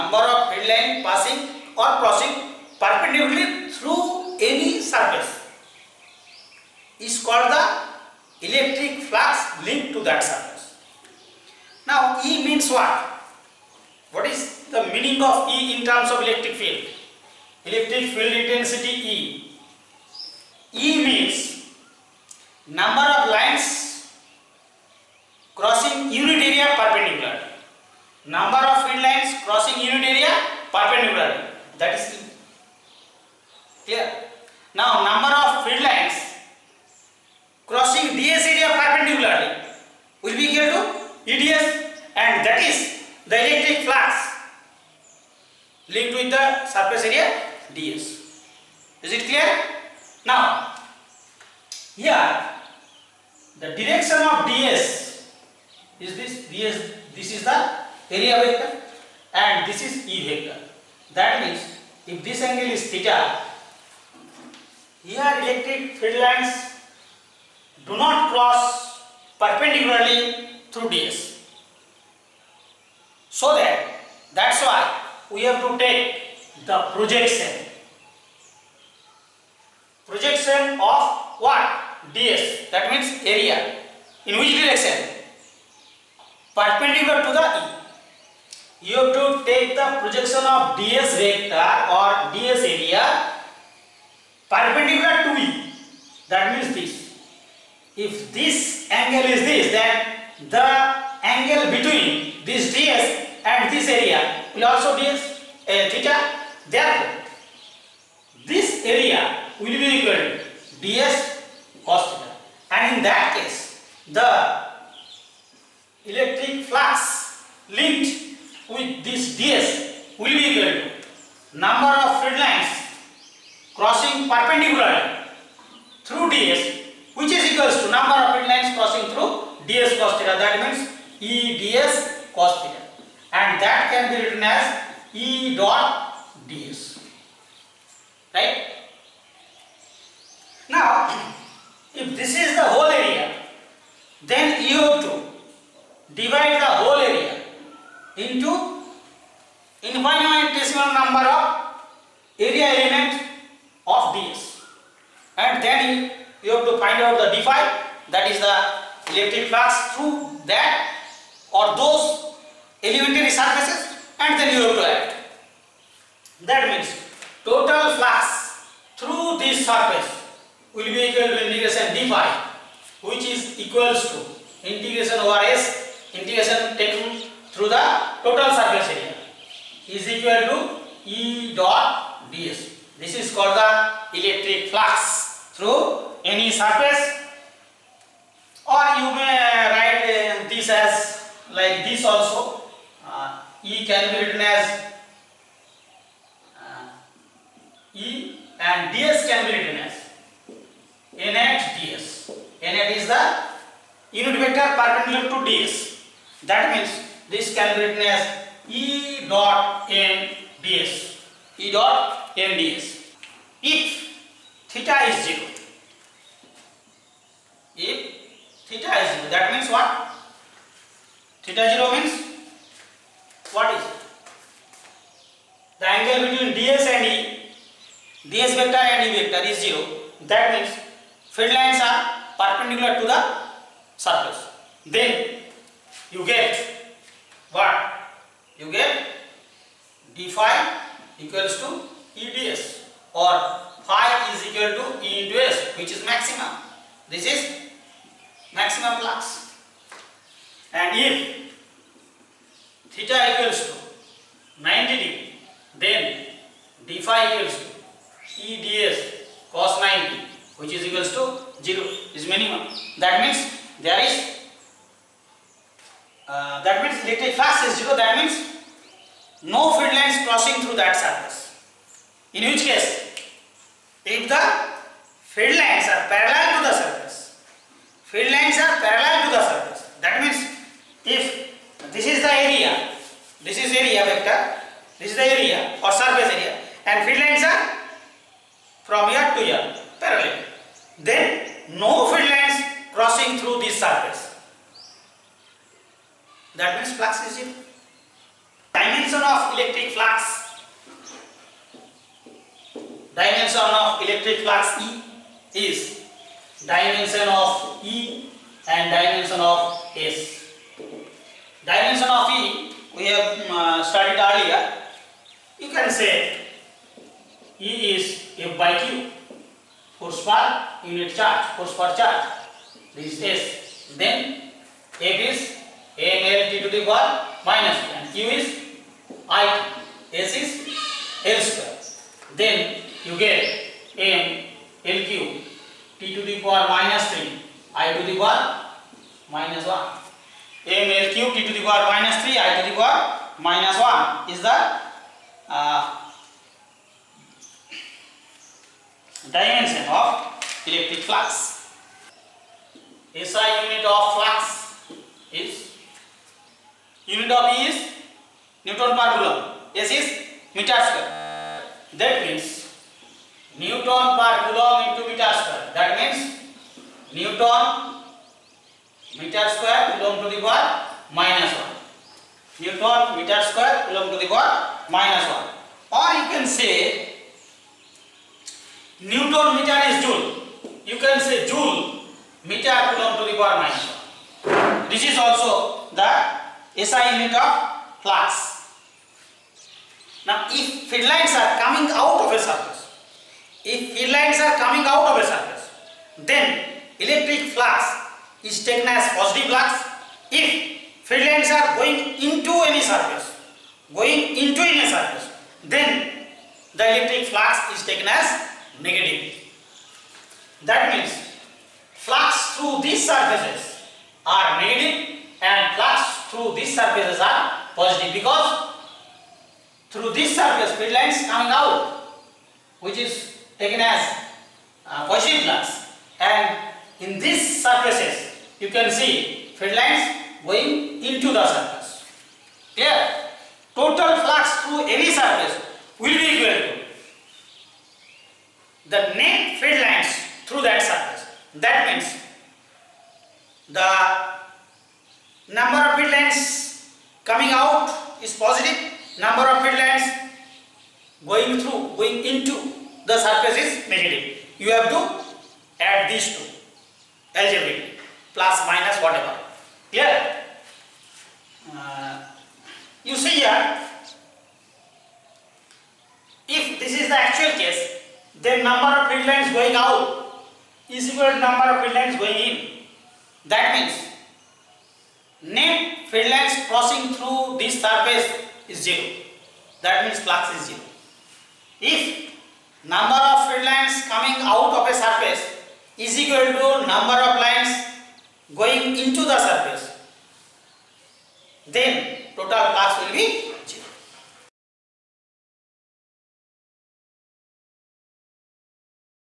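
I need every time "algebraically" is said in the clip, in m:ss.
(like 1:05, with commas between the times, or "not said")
7:37.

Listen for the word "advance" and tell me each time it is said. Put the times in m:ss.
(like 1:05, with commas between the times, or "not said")
not said.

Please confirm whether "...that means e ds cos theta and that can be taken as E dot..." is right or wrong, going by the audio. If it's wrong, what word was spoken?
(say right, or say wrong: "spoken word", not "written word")
wrong: "written", not "taken".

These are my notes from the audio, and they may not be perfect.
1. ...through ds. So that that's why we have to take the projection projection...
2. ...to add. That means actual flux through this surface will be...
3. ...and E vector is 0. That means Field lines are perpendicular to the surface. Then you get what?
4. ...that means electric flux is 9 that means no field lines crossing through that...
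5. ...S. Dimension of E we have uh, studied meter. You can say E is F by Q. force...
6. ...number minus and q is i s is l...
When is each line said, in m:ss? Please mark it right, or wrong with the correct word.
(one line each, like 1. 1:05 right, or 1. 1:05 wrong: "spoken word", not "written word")
1. 1:10 right
2. 2:44 wrong: "total", not "actual"
3. 3:48 right
4. 4:26 wrong: "0", not "9"
5. 5:09 wrong: "earlier", not "meter"
6. 5:26 wrong: "power", not "number".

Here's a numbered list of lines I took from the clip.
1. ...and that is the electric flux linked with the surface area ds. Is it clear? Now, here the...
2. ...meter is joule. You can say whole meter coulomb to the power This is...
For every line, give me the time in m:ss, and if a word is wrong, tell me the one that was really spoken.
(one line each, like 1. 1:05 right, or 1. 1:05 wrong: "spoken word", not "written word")
1. 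0:42 right
2. 6:19 wrong: "joule", not "whole".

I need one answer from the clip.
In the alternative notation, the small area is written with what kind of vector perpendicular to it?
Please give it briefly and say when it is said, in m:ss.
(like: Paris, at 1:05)
unit vector, at 3:24.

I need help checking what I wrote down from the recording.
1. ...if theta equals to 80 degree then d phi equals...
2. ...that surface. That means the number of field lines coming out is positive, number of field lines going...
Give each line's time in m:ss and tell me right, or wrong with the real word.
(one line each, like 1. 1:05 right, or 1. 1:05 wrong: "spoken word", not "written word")
1. 4:10 wrong: "90", not "80"
2. 7:20 right.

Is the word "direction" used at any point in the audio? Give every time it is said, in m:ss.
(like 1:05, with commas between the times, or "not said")
0:53, 1:24.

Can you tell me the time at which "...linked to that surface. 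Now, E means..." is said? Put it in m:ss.
0:09.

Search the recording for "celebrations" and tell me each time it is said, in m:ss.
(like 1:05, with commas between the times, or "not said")
not said.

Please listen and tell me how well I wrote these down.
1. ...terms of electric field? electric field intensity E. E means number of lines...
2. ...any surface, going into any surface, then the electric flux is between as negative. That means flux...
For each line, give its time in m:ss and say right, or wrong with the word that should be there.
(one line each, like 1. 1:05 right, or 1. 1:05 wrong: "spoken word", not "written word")
1. 0:15 right
2. 6:42 wrong: "taken", not "between".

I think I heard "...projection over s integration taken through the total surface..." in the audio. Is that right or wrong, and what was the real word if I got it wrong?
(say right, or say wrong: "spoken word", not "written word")
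wrong: "integration", not "projection".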